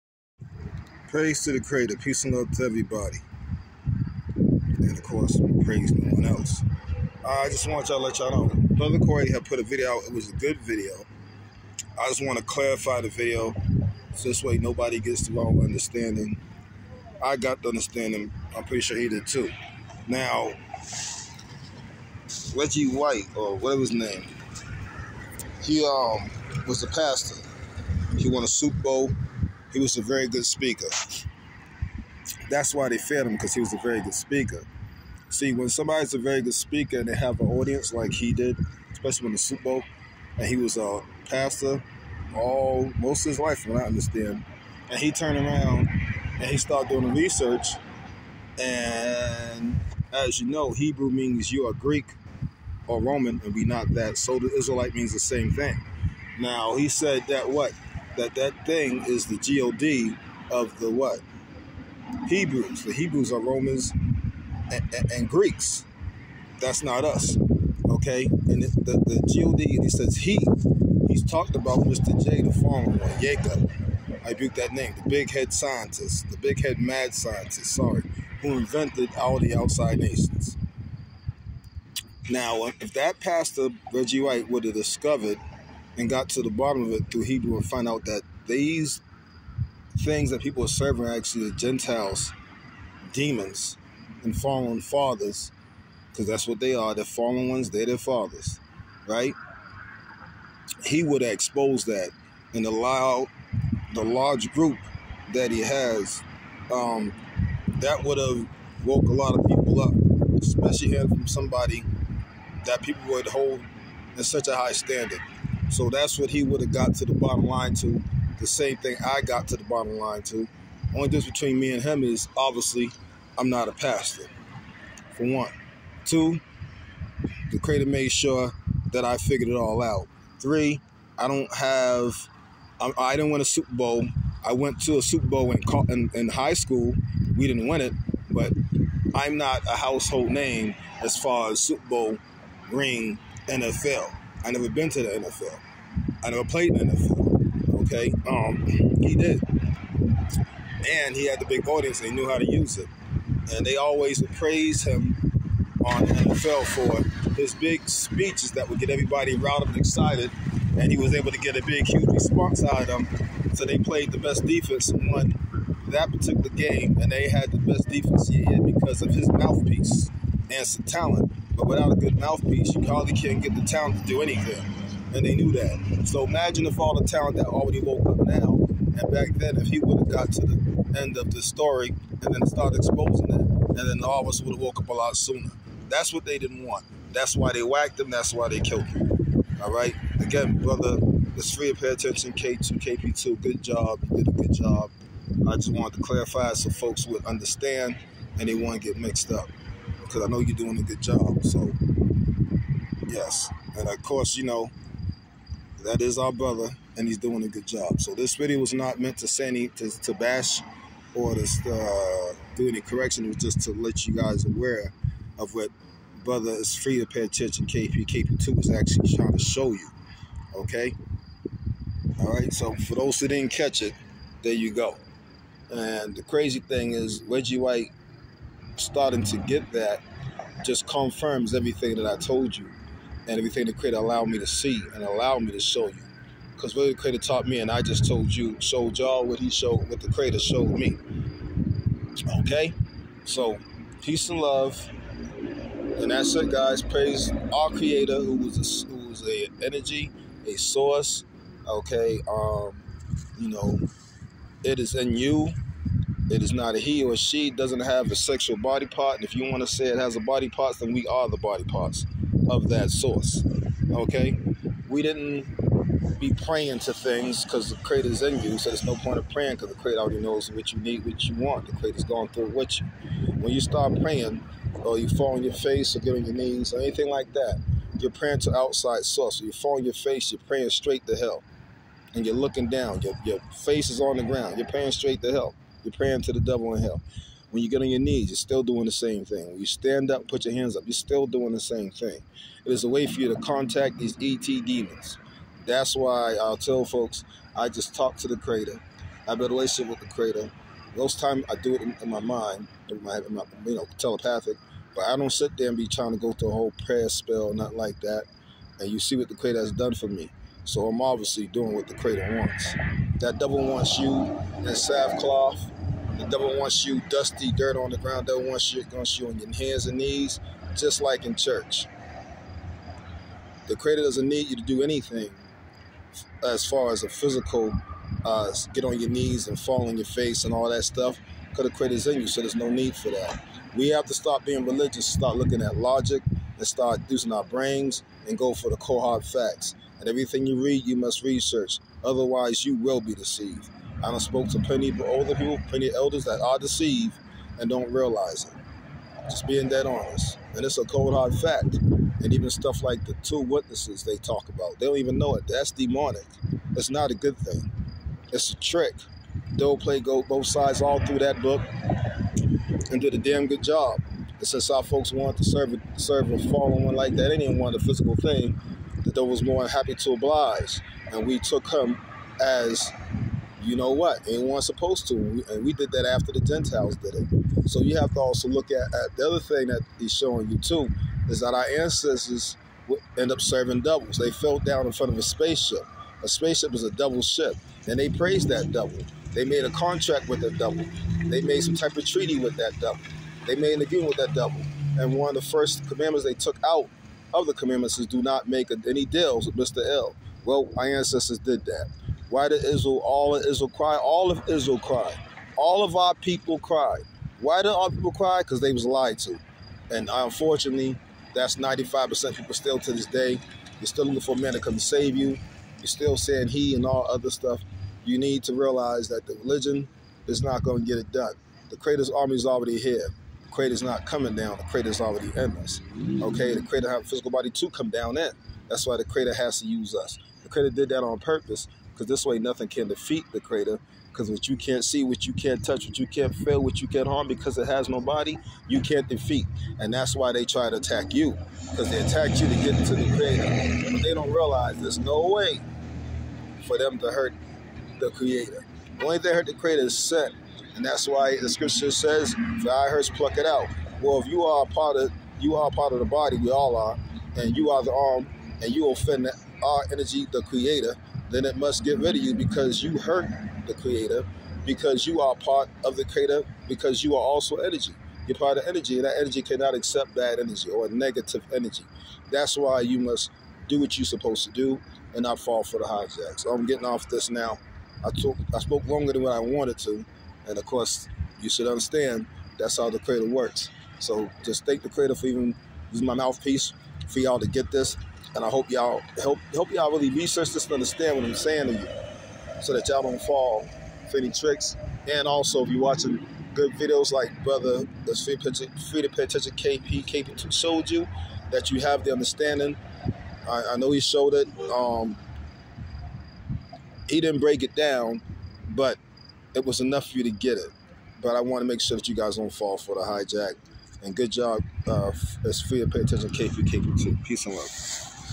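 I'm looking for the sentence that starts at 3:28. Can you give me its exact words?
So this video was not meant to say any to, to bash or to uh, do any correction.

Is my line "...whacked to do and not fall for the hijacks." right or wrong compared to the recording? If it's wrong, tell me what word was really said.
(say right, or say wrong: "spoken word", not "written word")
wrong: "supposed", not "whacked".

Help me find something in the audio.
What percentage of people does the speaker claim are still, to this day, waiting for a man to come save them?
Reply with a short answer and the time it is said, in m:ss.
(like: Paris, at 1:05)
95%, at 6:51.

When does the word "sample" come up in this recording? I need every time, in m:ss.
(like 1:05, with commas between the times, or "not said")
not said.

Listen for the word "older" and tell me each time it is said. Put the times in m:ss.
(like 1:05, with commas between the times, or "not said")
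5:45.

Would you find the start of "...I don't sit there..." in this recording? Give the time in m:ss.
5:05.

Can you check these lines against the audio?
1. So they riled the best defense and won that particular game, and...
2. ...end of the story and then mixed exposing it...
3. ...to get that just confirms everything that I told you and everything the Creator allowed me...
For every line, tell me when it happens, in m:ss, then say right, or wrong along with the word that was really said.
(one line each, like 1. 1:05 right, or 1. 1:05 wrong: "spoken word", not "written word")
1. 2:43 wrong: "played", not "riled"
2. 3:00 wrong: "started", not "mixed"
3. 3:49 right.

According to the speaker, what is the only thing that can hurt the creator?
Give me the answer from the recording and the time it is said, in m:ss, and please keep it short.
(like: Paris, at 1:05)
sin, at 7:29.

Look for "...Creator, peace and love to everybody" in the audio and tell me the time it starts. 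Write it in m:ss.
0:01.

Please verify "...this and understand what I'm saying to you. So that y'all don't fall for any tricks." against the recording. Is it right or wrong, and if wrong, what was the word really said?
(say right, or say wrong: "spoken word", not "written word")
right.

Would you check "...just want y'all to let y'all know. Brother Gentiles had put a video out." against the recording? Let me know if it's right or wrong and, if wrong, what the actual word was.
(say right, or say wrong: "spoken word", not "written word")
wrong: "Corey", not "Gentiles".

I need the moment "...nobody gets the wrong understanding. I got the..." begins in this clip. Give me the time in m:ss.
0:14.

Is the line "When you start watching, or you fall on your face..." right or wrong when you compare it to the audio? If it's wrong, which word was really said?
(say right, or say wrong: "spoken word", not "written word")
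wrong: "praying", not "watching".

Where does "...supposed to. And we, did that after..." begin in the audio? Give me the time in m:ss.
6:14.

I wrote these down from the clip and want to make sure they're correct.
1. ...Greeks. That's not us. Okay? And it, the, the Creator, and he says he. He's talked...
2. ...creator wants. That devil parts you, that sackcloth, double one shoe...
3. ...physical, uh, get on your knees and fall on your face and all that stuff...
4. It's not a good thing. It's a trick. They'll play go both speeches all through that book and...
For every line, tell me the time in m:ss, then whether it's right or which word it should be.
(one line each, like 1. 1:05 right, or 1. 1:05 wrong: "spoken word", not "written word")
1. 1:05 wrong: "God", not "Creator"
2. 5:11 wrong: "wants", not "parts"
3. 5:27 right
4. 5:56 wrong: "sides", not "speeches".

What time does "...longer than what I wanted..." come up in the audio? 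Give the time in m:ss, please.
7:58.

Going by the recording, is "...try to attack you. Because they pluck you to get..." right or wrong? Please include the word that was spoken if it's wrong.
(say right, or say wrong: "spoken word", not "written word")
wrong: "attack", not "pluck".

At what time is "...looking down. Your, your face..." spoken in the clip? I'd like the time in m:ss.
4:42.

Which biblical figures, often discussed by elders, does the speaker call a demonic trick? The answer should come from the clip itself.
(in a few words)
the two witnesses.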